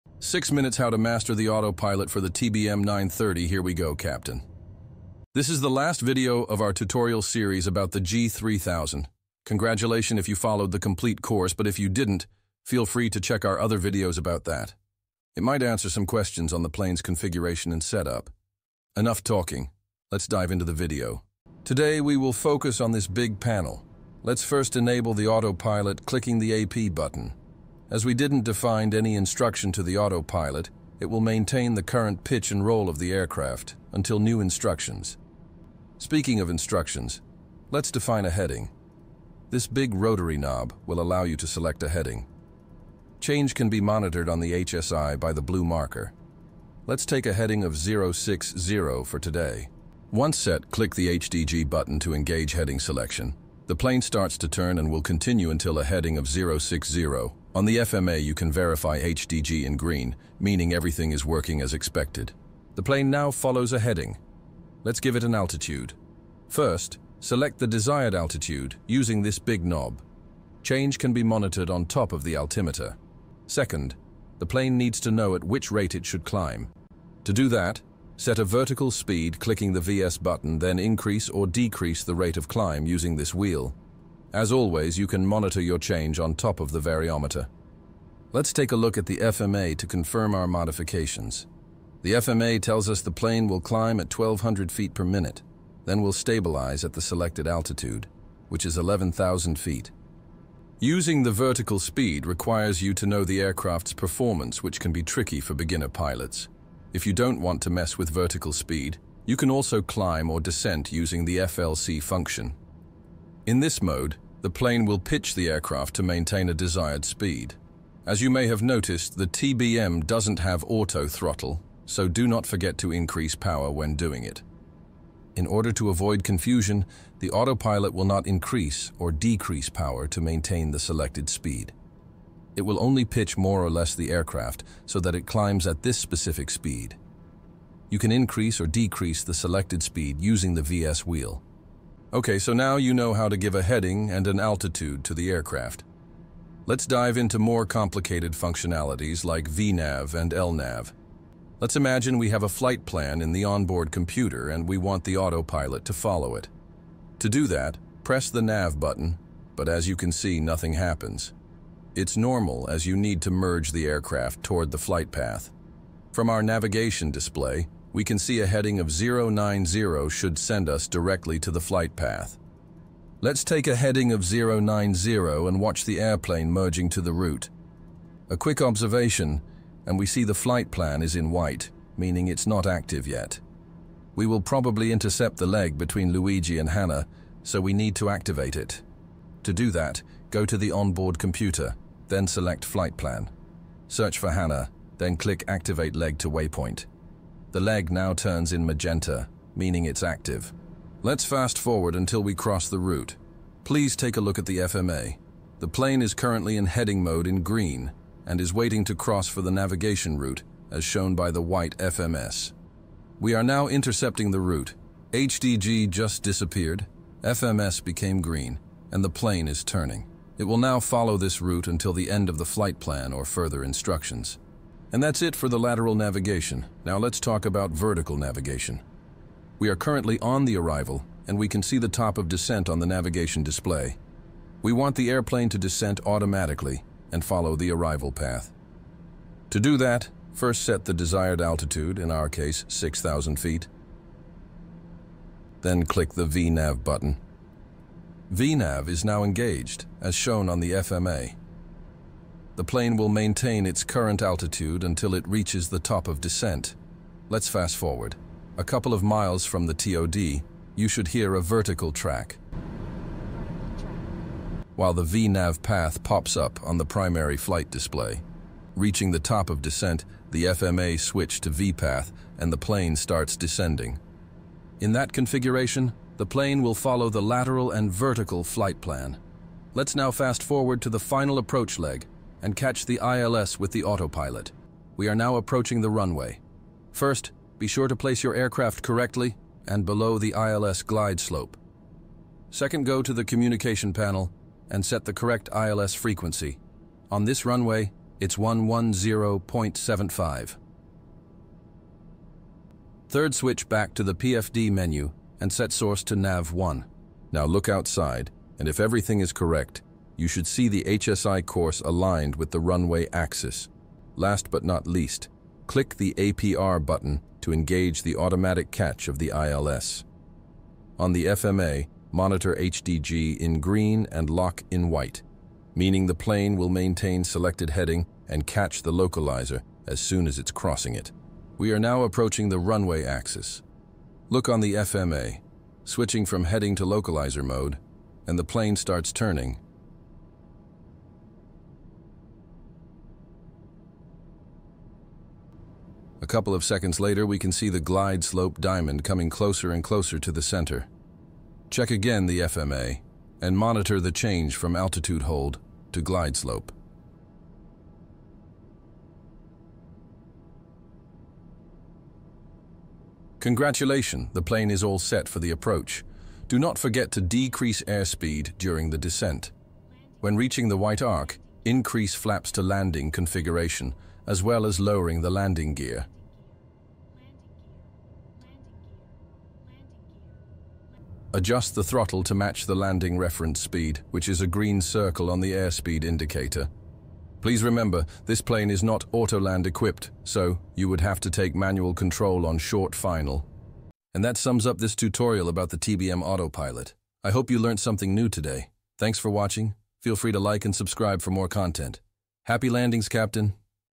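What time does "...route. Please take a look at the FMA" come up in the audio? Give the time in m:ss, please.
3:22.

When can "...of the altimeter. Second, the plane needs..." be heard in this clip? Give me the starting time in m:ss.
1:12.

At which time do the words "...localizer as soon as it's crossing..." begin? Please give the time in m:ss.
5:28.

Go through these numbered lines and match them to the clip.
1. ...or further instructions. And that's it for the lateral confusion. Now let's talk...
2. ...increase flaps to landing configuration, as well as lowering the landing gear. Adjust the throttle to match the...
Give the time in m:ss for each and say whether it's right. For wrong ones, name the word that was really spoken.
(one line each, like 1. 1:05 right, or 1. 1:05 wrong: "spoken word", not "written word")
1. 3:43 wrong: "navigation", not "confusion"
2. 6:11 right.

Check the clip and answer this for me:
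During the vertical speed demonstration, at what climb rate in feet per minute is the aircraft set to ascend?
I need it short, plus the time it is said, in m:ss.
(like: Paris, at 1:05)
1200, at 1:34.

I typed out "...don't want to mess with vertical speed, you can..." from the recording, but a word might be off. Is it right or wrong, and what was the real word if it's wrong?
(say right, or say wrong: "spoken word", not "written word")
right.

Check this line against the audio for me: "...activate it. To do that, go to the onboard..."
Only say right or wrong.
right.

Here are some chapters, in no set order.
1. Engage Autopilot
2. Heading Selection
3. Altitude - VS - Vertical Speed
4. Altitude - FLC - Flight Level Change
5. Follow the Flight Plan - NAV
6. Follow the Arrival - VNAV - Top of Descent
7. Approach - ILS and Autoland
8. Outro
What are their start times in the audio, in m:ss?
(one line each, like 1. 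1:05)
1. 0:21
2. 0:35
3. 1:02
4. 1:40
5. 2:22
6. 3:44
7. 4:44
8. 6:33.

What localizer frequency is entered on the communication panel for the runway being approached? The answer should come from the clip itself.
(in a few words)
110.75.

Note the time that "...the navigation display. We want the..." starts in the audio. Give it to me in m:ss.
3:52.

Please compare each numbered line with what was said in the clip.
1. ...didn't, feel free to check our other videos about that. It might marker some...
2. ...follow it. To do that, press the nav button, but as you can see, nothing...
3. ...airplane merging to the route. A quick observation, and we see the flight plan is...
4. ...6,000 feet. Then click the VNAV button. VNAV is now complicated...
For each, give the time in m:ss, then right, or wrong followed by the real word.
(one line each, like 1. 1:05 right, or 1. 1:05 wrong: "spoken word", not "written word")
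1. 0:11 wrong: "answer", not "marker"
2. 2:35 right
3. 2:55 right
4. 4:02 wrong: "engaged", not "complicated".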